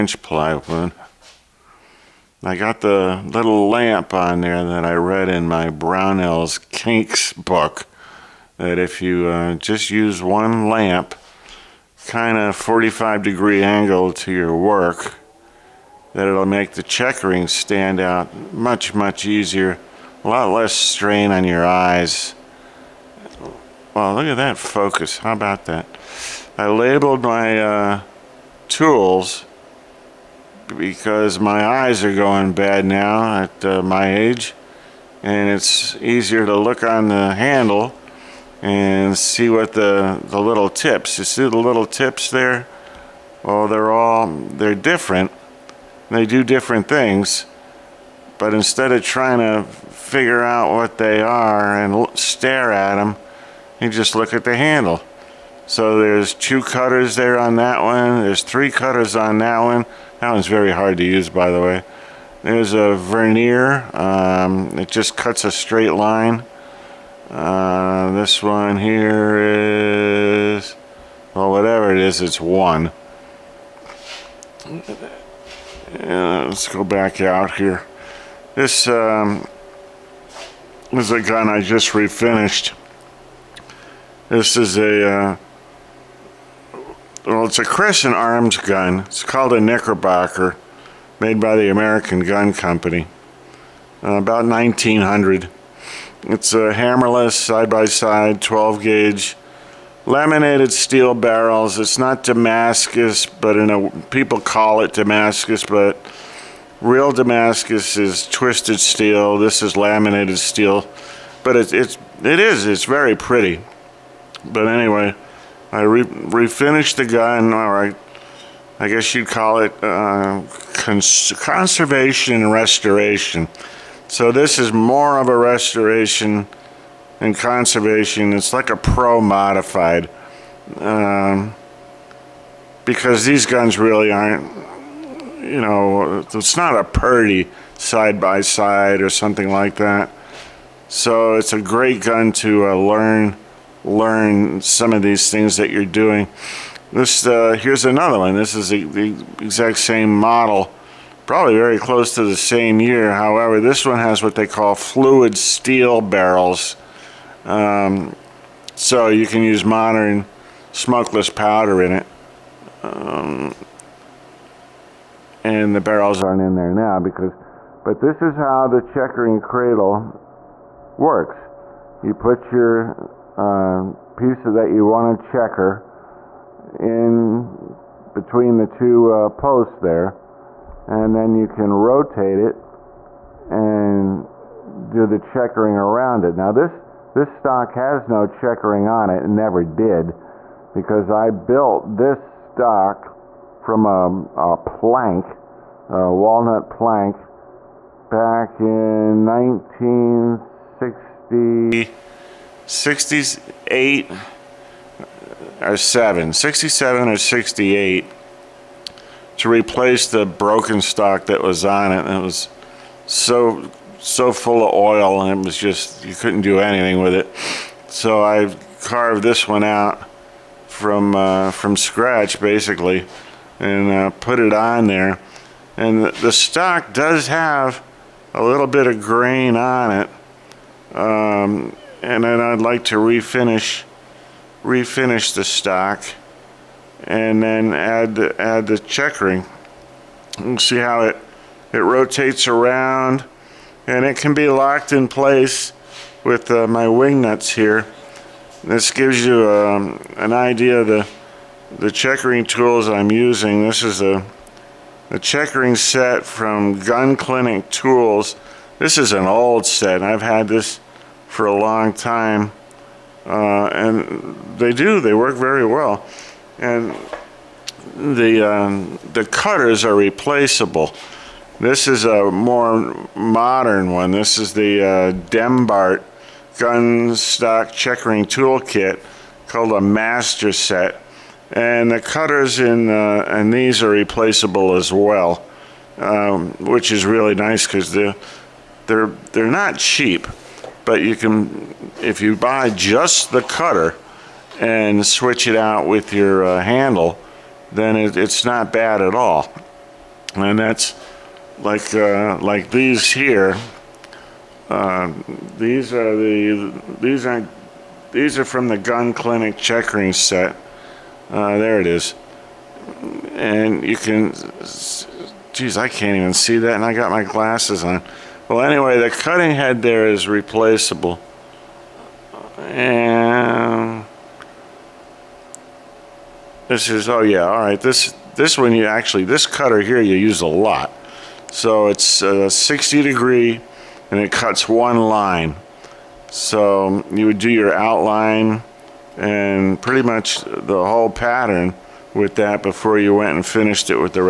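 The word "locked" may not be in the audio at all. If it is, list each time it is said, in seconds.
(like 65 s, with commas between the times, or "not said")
244 s.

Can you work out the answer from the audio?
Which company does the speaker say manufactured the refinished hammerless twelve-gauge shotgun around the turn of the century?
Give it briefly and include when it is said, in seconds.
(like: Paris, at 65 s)
American Gun Company, at 91 s.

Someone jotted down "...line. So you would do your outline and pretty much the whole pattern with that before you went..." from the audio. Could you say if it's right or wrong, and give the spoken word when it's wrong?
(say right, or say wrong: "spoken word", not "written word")
right.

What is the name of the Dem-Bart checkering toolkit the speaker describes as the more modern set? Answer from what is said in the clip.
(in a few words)
master set.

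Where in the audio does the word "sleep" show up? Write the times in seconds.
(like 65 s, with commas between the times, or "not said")
not said.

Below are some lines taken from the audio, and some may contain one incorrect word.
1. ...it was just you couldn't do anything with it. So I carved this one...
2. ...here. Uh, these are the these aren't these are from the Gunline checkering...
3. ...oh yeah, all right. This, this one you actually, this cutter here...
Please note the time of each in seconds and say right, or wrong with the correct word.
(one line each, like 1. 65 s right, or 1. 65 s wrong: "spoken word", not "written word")
1. 215 s right
2. 303 s right
3. 327 s right.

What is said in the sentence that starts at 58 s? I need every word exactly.
There's three cutters on that one.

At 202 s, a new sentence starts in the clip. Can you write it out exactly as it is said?
68 uh, or 7, 67 or 68 to replace the broken stock that was on it.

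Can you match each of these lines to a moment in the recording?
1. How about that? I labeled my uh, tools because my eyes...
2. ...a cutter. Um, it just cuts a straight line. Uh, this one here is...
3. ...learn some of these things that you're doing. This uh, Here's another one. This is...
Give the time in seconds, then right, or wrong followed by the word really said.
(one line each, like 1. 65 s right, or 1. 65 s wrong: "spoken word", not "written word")
1. 25 s right
2. 62 s wrong: "vernier", not "cutter"
3. 143 s right.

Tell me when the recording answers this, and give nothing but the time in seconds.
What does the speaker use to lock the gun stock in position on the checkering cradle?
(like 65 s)
246 s.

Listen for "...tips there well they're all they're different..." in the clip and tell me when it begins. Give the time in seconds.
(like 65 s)
41 s.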